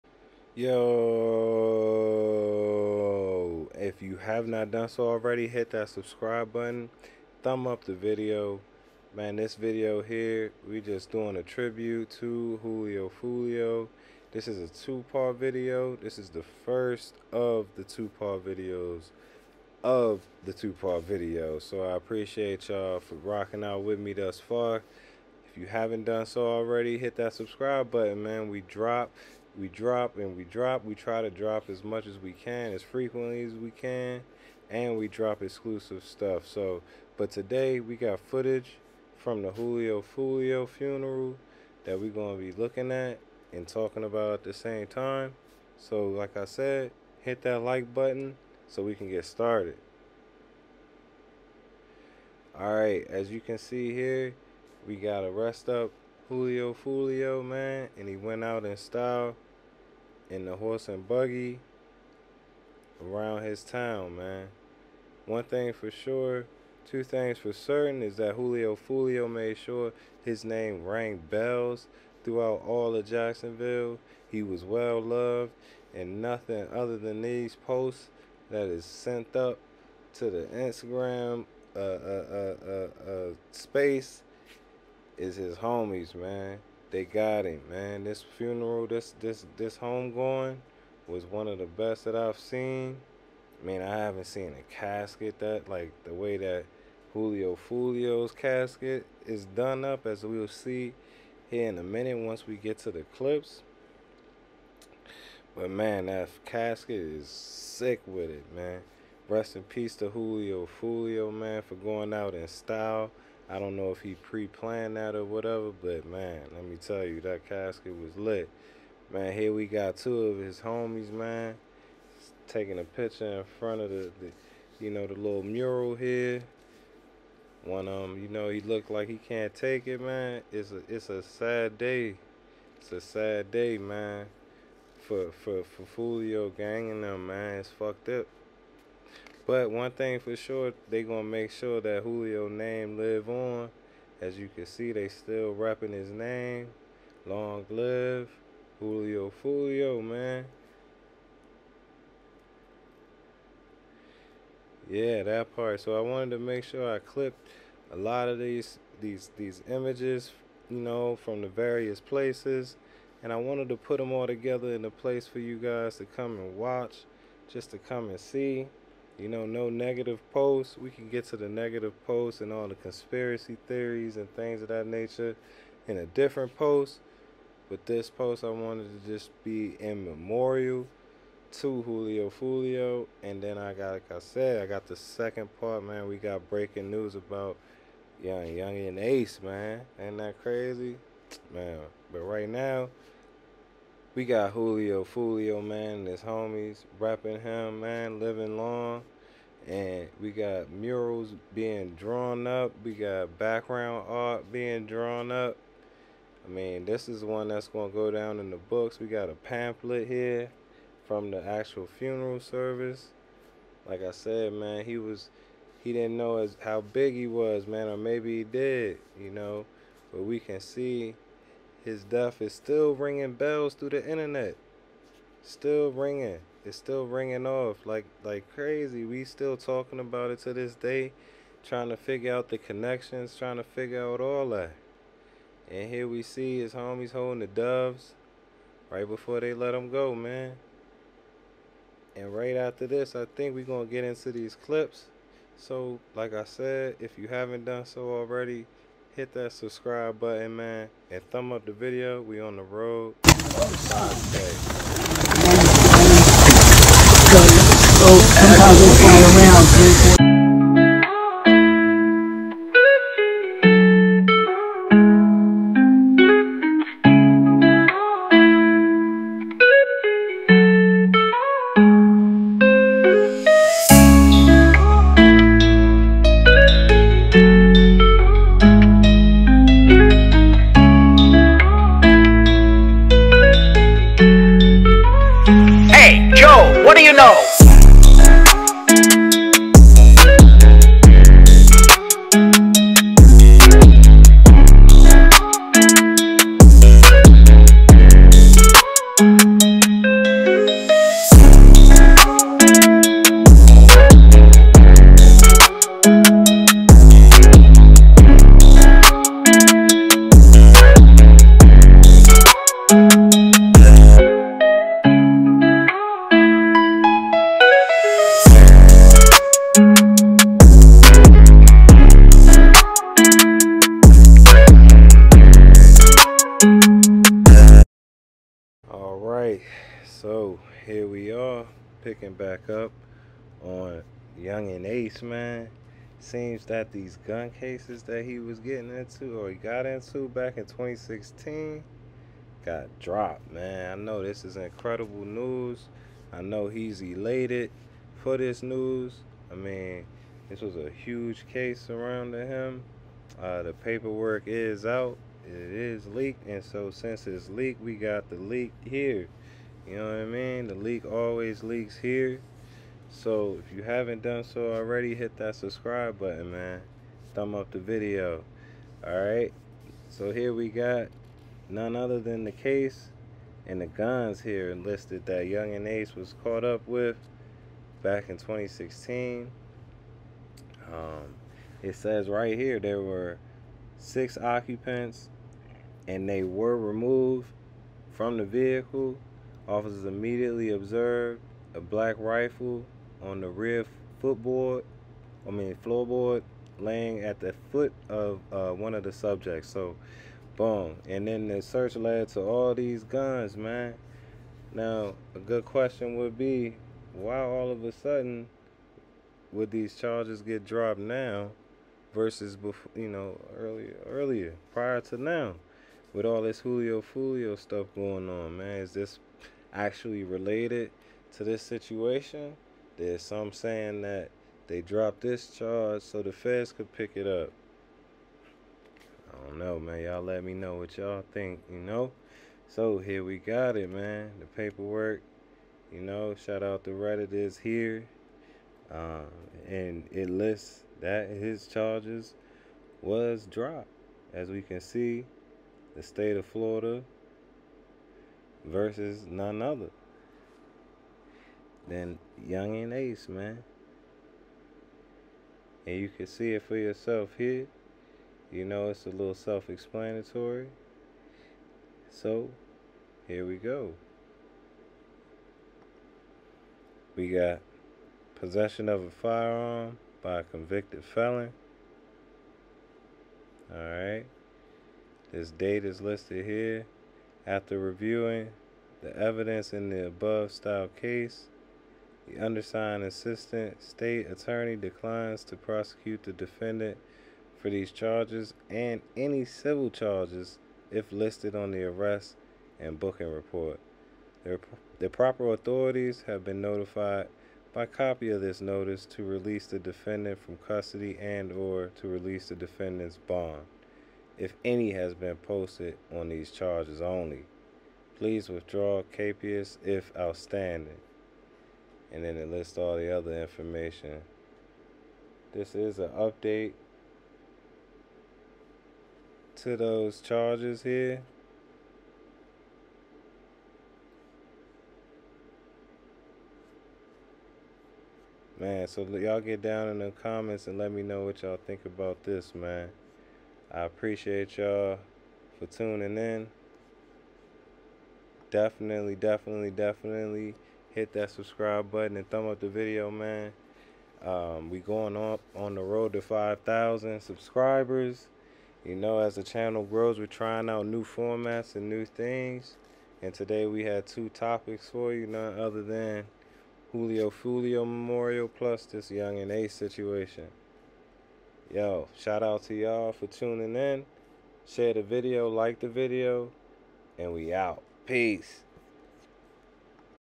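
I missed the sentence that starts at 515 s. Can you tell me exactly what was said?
This is an update to those charges here.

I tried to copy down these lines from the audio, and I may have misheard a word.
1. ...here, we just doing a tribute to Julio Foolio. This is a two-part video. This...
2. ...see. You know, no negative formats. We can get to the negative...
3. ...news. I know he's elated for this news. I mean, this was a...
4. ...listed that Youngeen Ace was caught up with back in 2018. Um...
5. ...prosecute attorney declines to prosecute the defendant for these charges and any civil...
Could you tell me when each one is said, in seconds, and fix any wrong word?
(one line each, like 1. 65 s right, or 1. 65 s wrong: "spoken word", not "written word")
1. 10 s right
2. 168 s wrong: "posts", not "formats"
3. 345 s right
4. 374 s wrong: "2016", not "2018"
5. 483 s wrong: "state", not "prosecute".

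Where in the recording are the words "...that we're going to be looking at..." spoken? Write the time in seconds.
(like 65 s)
41 s.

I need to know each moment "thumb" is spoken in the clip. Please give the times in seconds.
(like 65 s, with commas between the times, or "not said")
7 s, 251 s, 367 s, 542 s.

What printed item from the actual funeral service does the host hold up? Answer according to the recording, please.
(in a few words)
A pamphlet.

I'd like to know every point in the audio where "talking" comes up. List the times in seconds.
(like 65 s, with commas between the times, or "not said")
43 s, 229 s.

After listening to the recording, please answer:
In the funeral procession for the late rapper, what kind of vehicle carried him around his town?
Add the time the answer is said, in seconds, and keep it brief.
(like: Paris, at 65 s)
Horse and buggy, at 60 s.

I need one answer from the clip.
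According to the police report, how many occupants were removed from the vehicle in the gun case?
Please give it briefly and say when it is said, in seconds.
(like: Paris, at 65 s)
6, at 383 s.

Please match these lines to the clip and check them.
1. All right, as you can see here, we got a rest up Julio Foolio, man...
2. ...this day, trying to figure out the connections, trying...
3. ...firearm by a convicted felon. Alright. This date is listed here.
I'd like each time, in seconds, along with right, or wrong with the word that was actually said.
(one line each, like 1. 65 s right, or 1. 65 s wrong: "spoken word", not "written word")
1. 52 s right
2. 230 s right
3. 469 s right.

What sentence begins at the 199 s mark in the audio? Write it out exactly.
And we got murals being drawn up.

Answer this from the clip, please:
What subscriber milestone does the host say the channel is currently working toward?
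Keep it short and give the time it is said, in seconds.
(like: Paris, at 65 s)
5,000, at 546 s.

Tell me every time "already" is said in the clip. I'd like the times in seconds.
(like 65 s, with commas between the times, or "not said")
5 s, 26 s, 248 s, 364 s.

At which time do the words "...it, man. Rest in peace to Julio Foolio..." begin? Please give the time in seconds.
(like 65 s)
108 s.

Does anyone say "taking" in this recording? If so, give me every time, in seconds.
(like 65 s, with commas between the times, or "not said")
122 s.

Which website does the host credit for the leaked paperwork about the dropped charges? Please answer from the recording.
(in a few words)
Reddit.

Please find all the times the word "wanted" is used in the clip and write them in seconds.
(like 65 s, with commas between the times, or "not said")
156 s, 163 s, 178 s.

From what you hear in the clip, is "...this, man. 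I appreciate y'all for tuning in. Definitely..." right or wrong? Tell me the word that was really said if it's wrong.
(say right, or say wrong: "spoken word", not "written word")
right.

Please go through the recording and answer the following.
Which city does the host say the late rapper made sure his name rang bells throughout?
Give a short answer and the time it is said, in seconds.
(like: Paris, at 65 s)
Jacksonville, at 73 s.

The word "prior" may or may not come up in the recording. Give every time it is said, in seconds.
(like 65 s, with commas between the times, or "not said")
414 s.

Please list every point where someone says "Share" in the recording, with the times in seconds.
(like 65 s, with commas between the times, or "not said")
564 s.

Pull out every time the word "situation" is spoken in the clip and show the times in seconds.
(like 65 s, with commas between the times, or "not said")
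421 s, 559 s.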